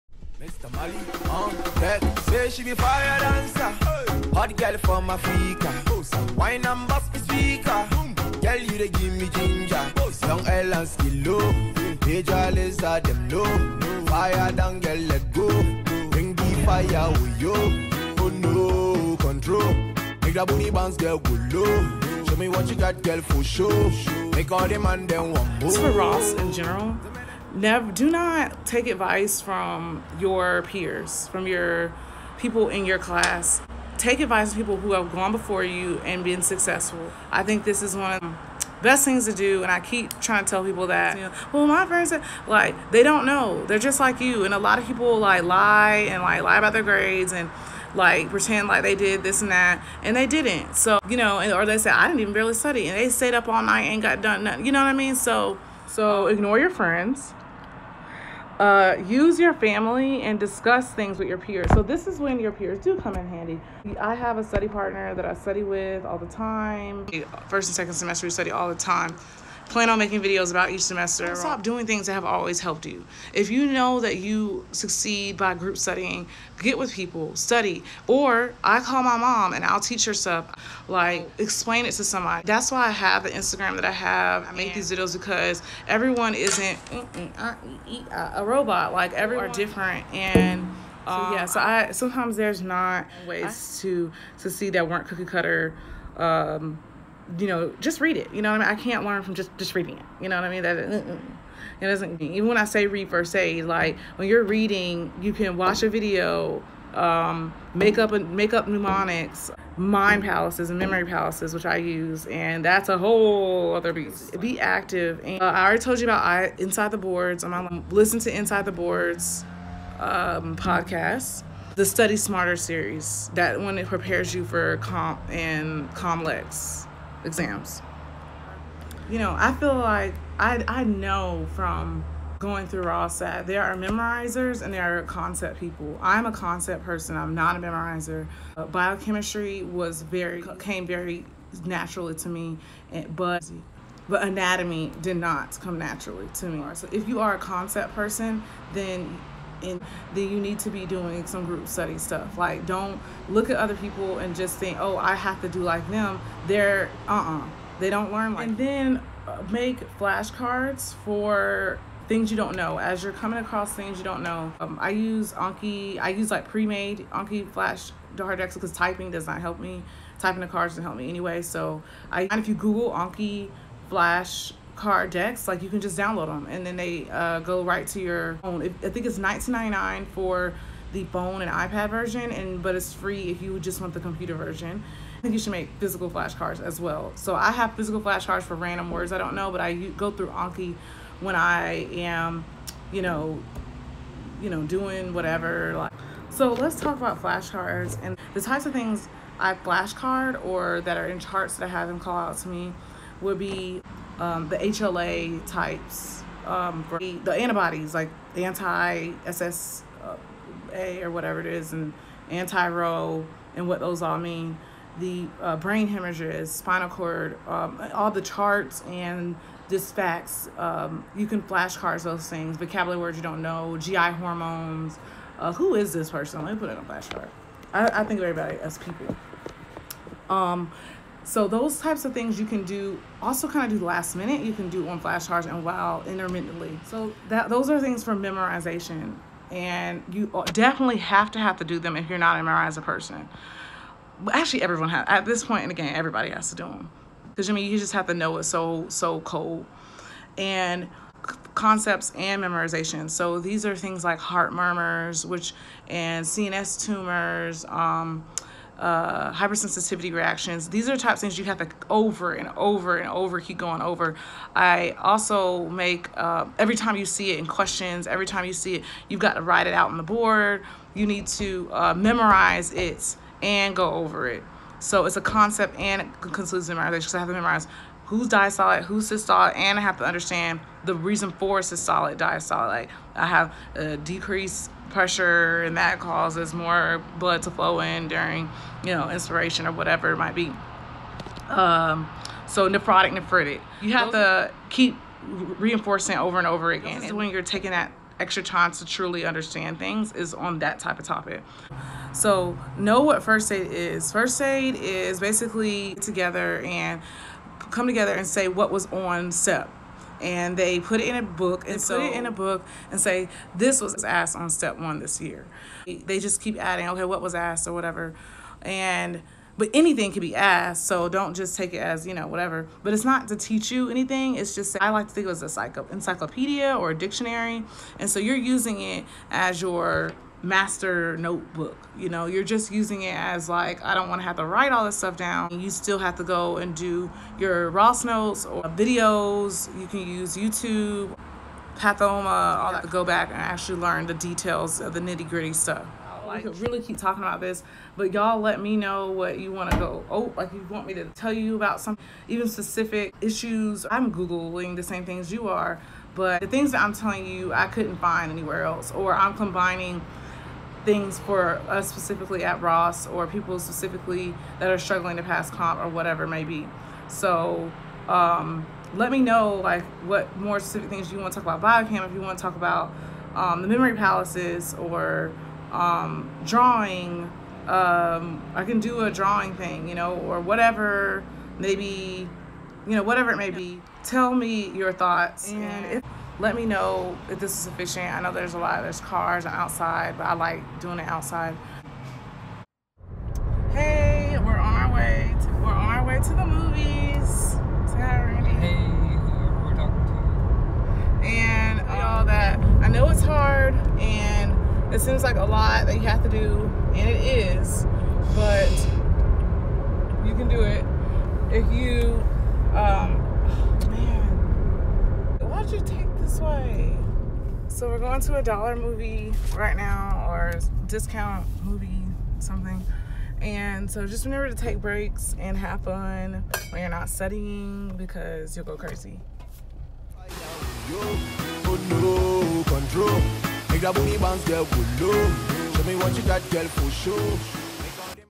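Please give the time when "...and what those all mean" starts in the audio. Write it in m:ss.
3:33.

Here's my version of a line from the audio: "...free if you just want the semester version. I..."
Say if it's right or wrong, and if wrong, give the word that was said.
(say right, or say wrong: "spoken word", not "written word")
wrong: "computer", not "semester".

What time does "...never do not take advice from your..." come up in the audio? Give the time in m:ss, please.
0:27.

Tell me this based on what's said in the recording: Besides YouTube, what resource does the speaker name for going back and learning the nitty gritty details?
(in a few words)
Pathoma.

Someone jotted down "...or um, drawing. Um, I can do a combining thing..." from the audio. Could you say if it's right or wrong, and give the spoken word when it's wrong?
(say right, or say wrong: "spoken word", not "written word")
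wrong: "drawing", not "combining".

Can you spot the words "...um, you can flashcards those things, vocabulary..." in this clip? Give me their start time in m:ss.
3:40.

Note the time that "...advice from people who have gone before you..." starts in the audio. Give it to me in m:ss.
0:34.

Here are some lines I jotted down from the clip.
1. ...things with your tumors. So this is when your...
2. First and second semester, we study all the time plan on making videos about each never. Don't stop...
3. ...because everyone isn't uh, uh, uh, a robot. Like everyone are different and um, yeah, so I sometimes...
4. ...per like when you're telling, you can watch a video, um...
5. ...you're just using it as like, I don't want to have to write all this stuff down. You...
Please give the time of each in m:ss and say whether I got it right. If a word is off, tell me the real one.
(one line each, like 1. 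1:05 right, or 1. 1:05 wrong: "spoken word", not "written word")
1. 1:00 wrong: "peers", not "tumors"
2. 1:07 wrong: "semester", not "never"
3. 1:25 right
4. 1:43 wrong: "reading", not "telling"
5. 5:32 right.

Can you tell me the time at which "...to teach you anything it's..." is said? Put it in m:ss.
5:23.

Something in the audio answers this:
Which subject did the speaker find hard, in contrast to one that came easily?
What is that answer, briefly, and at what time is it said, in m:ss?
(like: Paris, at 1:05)
Anatomy, at 2:24.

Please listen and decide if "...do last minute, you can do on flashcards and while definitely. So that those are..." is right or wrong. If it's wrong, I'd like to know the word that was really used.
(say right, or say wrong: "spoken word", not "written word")
wrong: "intermittently", not "definitely".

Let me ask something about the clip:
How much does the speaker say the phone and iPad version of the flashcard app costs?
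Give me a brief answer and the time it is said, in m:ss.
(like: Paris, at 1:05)
$19.99, at 2:59.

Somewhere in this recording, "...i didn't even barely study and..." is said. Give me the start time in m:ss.
0:51.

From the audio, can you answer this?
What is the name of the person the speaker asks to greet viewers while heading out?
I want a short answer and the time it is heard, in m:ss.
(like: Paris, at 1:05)
Randy, at 6:38.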